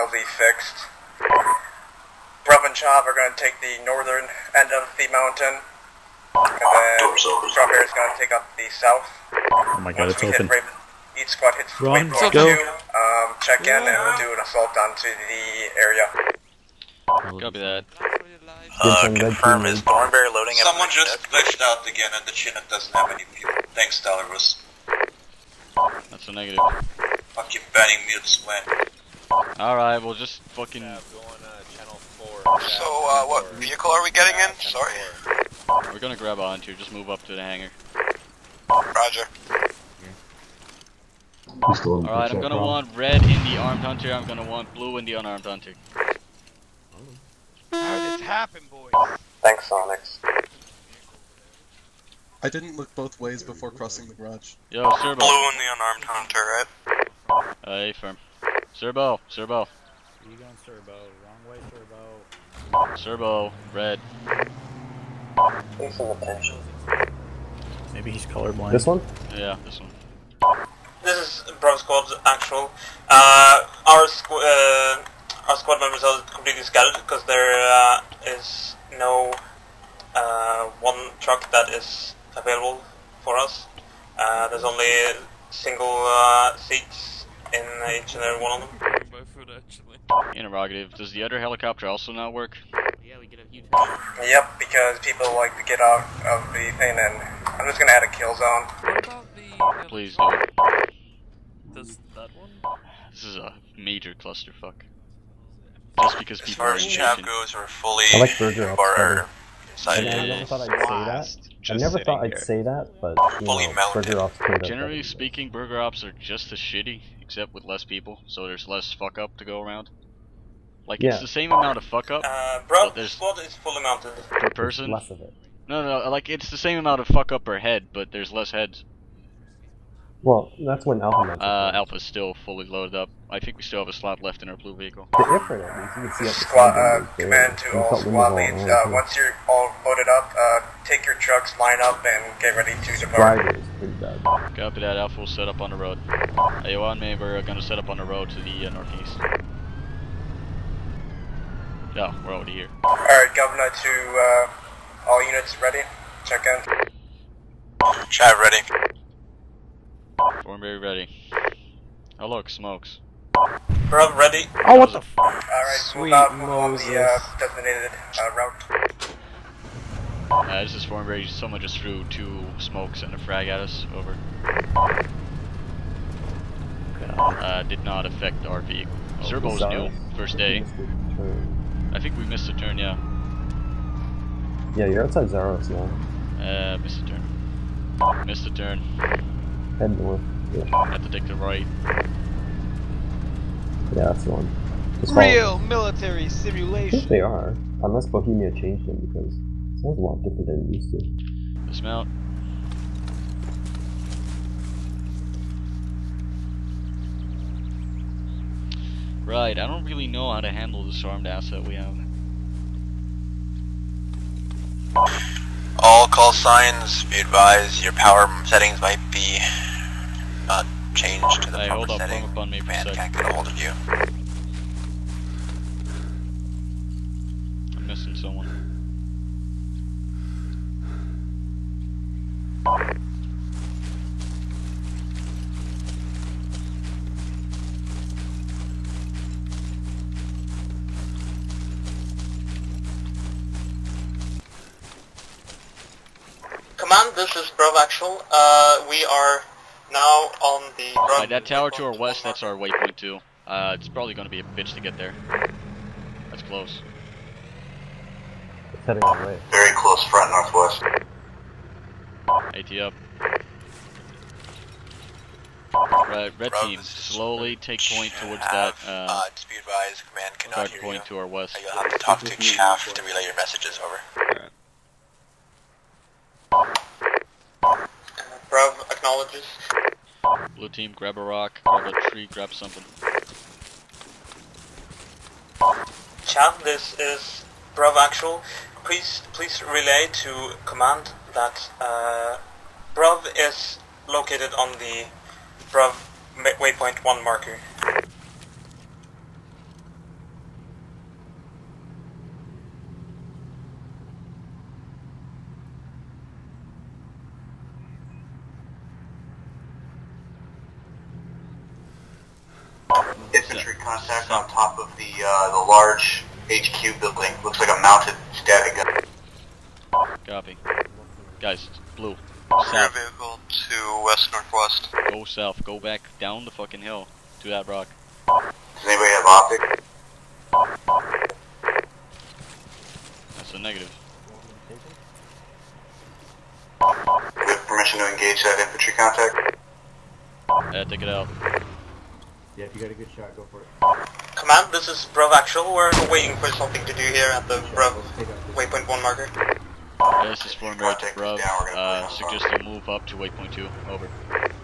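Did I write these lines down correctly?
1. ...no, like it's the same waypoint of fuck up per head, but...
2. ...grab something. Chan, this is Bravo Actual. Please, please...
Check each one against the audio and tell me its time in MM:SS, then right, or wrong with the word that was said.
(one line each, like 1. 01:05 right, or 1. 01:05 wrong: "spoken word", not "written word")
1. 02:06 wrong: "amount", not "waypoint"
2. 04:42 right.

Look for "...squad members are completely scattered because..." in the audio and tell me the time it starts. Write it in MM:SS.
01:15.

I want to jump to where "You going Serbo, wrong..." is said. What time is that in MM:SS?
01:00.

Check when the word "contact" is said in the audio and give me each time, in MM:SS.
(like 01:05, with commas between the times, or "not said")
05:13, 05:38.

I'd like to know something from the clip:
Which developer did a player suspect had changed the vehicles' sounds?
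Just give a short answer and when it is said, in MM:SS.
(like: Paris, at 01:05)
Bohemia, at 03:18.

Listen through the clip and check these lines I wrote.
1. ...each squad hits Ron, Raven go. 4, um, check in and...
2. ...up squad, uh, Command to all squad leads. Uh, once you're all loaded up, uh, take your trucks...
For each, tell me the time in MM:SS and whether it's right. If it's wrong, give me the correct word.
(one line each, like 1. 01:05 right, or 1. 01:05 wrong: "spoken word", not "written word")
1. 00:11 wrong: "2", not "4"
2. 02:16 right.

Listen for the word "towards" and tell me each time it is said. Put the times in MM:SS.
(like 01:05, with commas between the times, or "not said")
04:28.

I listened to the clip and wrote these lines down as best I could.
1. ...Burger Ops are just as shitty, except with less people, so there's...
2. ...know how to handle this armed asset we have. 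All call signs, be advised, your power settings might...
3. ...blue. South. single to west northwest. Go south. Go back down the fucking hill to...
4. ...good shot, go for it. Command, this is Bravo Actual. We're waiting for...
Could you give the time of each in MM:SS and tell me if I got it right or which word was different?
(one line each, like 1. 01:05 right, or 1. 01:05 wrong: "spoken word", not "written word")
1. 01:55 right
2. 03:30 right
3. 05:21 wrong: "vehicle", not "single"
4. 05:42 right.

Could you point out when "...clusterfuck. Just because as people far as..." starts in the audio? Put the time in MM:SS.
01:44.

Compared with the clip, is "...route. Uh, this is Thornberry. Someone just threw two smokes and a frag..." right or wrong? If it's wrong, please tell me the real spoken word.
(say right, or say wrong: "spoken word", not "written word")
right.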